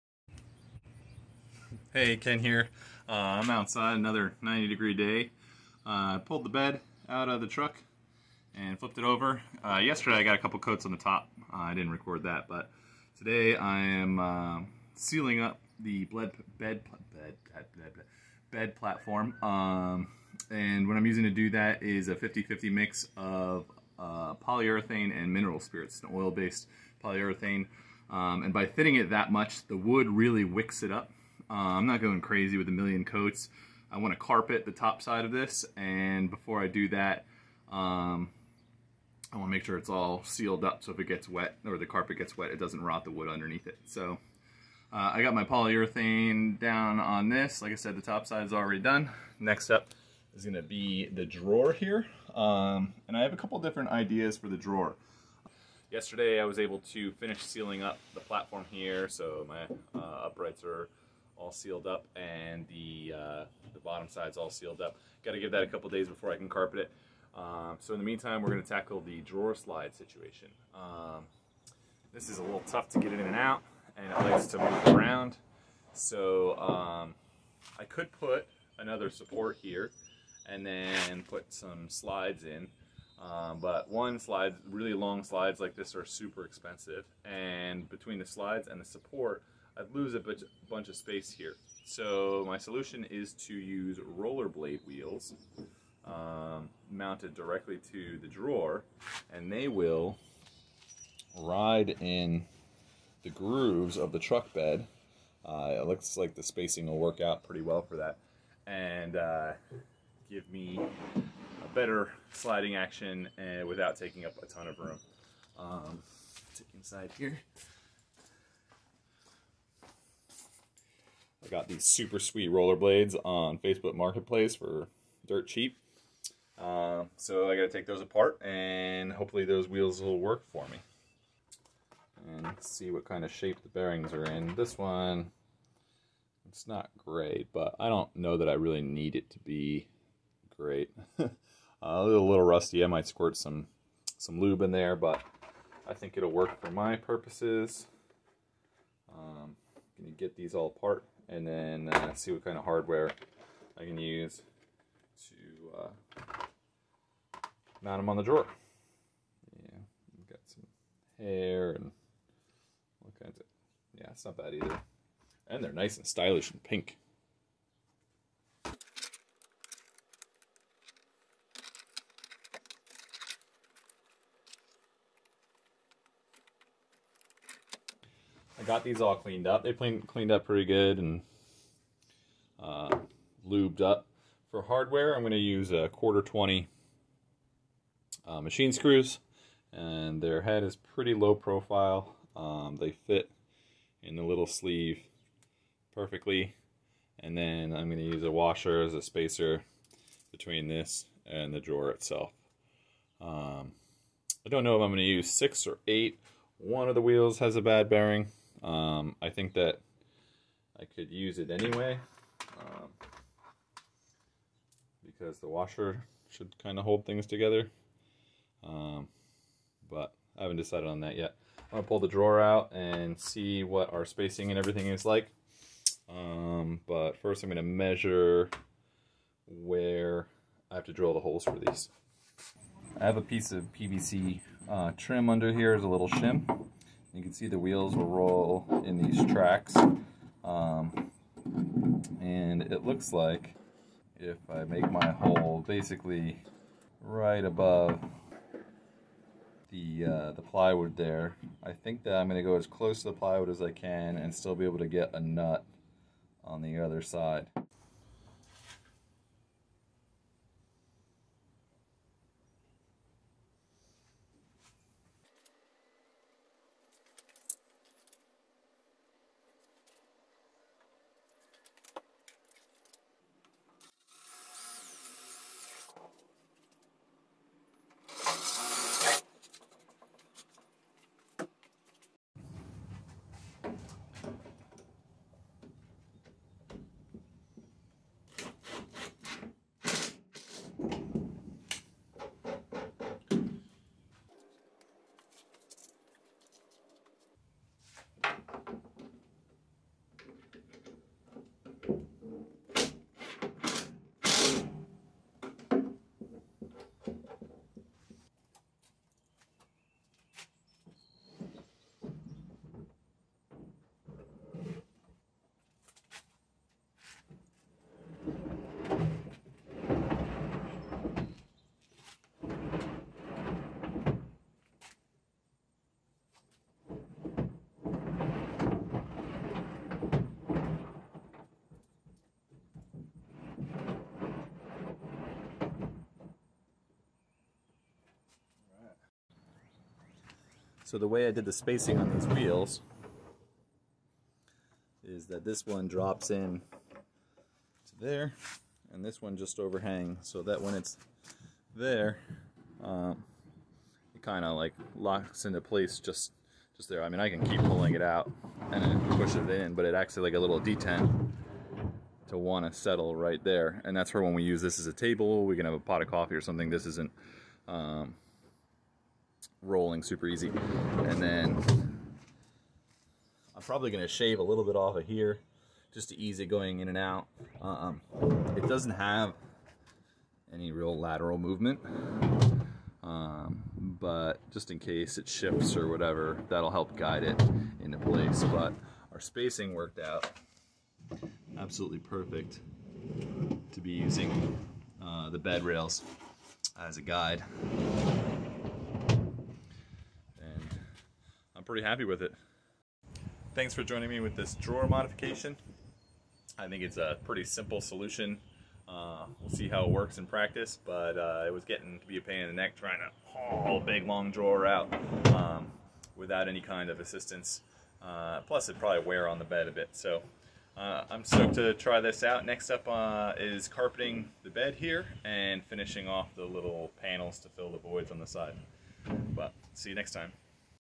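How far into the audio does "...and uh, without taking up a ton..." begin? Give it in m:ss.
1:53.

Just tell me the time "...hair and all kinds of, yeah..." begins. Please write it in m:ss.
2:41.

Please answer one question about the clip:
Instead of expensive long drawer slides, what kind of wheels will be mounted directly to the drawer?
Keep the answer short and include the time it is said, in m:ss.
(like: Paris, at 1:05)
Rollerblade wheels, at 1:34.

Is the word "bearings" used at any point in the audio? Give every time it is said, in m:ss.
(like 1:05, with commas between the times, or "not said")
2:13, 3:27.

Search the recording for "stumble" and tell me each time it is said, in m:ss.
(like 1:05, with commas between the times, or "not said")
not said.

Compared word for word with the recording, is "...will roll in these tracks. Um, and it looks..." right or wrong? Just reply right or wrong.
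right.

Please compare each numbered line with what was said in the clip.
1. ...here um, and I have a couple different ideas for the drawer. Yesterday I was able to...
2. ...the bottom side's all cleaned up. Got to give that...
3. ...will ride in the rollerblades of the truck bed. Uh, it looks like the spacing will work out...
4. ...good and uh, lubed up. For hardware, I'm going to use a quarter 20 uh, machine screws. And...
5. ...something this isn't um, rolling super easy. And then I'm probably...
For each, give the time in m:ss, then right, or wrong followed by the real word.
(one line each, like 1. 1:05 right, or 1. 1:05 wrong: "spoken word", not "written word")
1. 0:51 right
2. 1:03 wrong: "sealed", not "cleaned"
3. 1:39 wrong: "grooves", not "rollerblades"
4. 3:00 right
5. 6:06 right.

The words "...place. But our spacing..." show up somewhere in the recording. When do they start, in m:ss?
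6:27.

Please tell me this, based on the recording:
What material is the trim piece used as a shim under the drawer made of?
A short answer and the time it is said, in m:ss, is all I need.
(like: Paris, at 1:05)
PVC, at 3:53.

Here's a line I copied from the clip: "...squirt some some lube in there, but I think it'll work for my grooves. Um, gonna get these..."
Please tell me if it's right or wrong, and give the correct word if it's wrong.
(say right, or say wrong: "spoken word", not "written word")
wrong: "purposes", not "grooves".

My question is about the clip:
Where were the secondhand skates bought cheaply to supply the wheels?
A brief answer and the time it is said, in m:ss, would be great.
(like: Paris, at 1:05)
Facebook Marketplace, at 2:03.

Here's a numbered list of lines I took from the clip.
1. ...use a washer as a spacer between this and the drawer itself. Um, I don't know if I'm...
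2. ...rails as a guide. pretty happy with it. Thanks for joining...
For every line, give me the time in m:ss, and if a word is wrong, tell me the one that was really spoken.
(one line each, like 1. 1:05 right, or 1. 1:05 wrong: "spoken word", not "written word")
1. 3:18 right
2. 6:35 right.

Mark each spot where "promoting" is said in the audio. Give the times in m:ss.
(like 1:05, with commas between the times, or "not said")
not said.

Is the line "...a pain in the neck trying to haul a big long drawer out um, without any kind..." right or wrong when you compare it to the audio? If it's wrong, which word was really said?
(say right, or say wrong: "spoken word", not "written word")
right.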